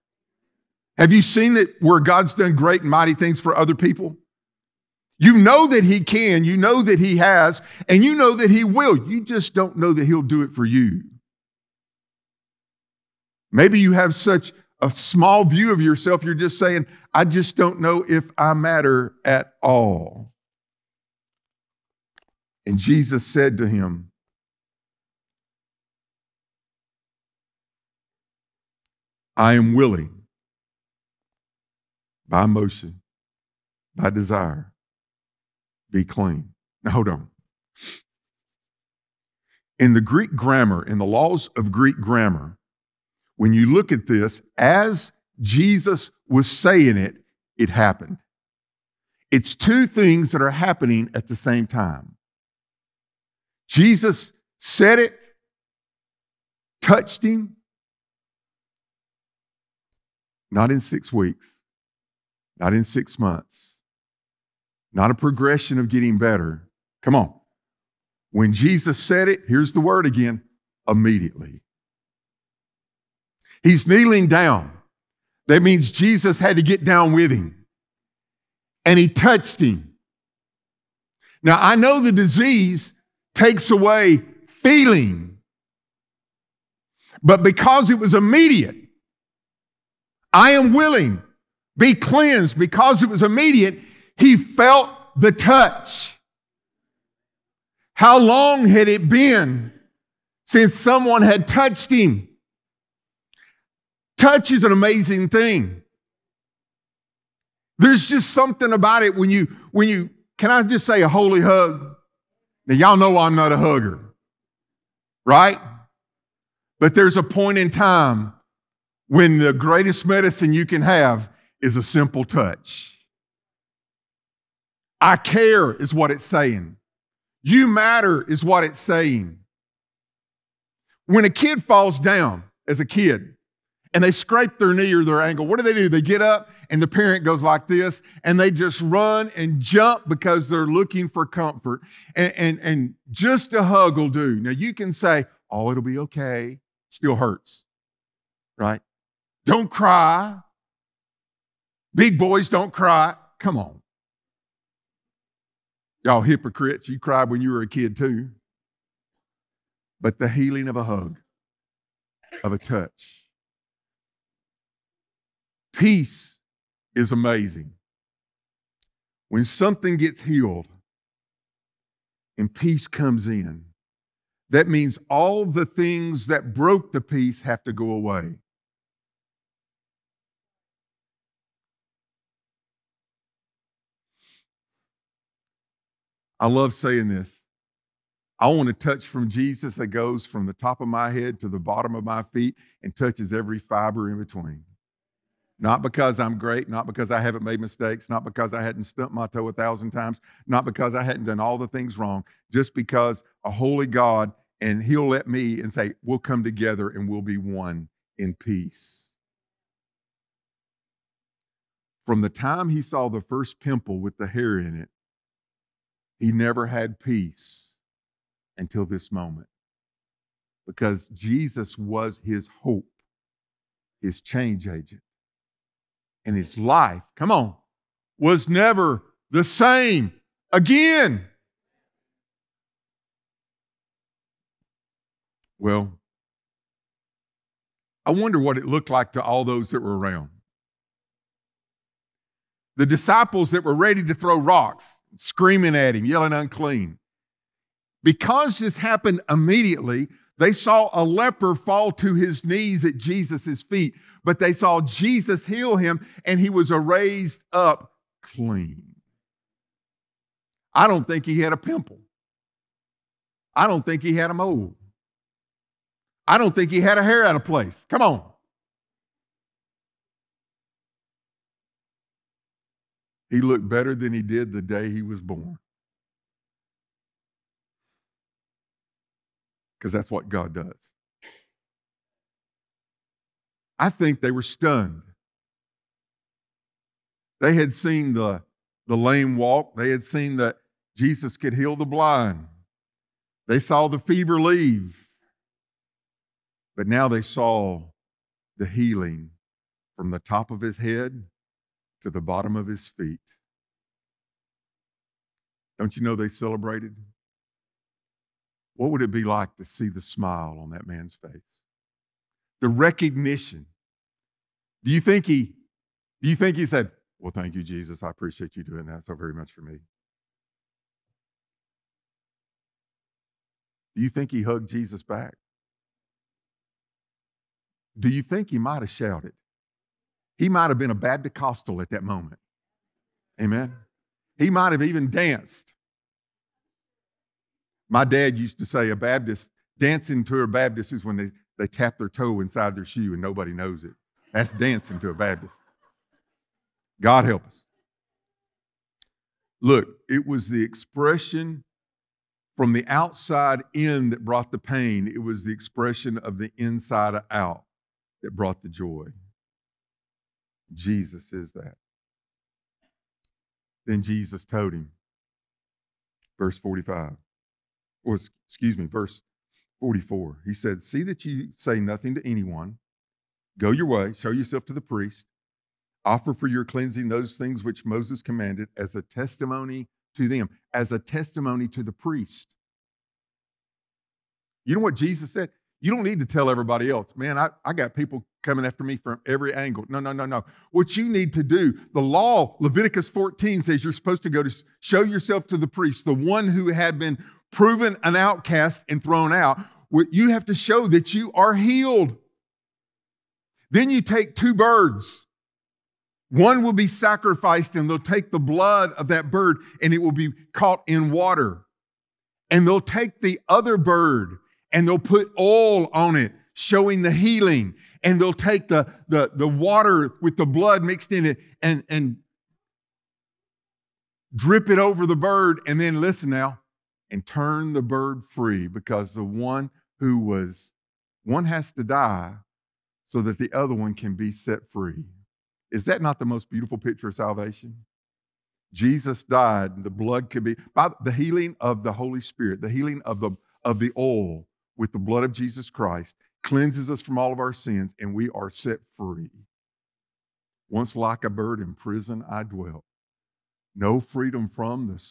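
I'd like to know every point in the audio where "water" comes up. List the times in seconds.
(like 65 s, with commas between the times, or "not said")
411 s, 419 s.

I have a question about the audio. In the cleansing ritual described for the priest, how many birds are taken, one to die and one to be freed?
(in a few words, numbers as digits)
2.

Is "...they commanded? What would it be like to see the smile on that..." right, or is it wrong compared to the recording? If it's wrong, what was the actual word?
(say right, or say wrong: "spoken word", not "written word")
wrong: "celebrated", not "commanded".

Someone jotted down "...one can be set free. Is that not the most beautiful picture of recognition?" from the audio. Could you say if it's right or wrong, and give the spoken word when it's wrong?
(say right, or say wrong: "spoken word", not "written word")
wrong: "salvation", not "recognition".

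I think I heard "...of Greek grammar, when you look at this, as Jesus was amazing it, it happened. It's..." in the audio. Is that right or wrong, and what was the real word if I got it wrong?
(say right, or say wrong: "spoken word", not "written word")
wrong: "saying", not "amazing".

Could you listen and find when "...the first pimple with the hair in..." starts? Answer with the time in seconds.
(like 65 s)
213 s.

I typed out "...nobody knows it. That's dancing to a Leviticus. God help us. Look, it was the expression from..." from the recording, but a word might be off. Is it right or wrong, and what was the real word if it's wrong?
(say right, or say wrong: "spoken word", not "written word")
wrong: "Baptist", not "Leviticus".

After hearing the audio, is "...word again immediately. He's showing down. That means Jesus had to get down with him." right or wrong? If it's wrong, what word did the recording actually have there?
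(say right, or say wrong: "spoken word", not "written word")
wrong: "kneeling", not "showing".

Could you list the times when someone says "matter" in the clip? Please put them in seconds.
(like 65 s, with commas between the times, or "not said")
18 s, 127 s.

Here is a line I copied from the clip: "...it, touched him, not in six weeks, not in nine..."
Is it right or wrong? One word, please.
wrong.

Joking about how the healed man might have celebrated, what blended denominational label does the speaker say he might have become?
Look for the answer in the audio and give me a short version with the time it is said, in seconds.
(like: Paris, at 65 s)
Baptist Costal, at 330 s.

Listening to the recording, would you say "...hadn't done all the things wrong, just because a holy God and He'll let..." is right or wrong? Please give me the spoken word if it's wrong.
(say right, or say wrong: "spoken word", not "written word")
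right.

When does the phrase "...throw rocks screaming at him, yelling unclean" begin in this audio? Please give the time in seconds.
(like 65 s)
244 s.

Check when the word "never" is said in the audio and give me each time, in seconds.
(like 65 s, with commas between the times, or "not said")
216 s, 228 s.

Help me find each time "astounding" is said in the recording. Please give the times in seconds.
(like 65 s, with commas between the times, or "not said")
not said.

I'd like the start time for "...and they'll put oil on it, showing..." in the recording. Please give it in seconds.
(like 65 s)
414 s.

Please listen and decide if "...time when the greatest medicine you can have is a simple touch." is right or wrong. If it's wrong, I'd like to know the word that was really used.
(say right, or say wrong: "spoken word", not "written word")
right.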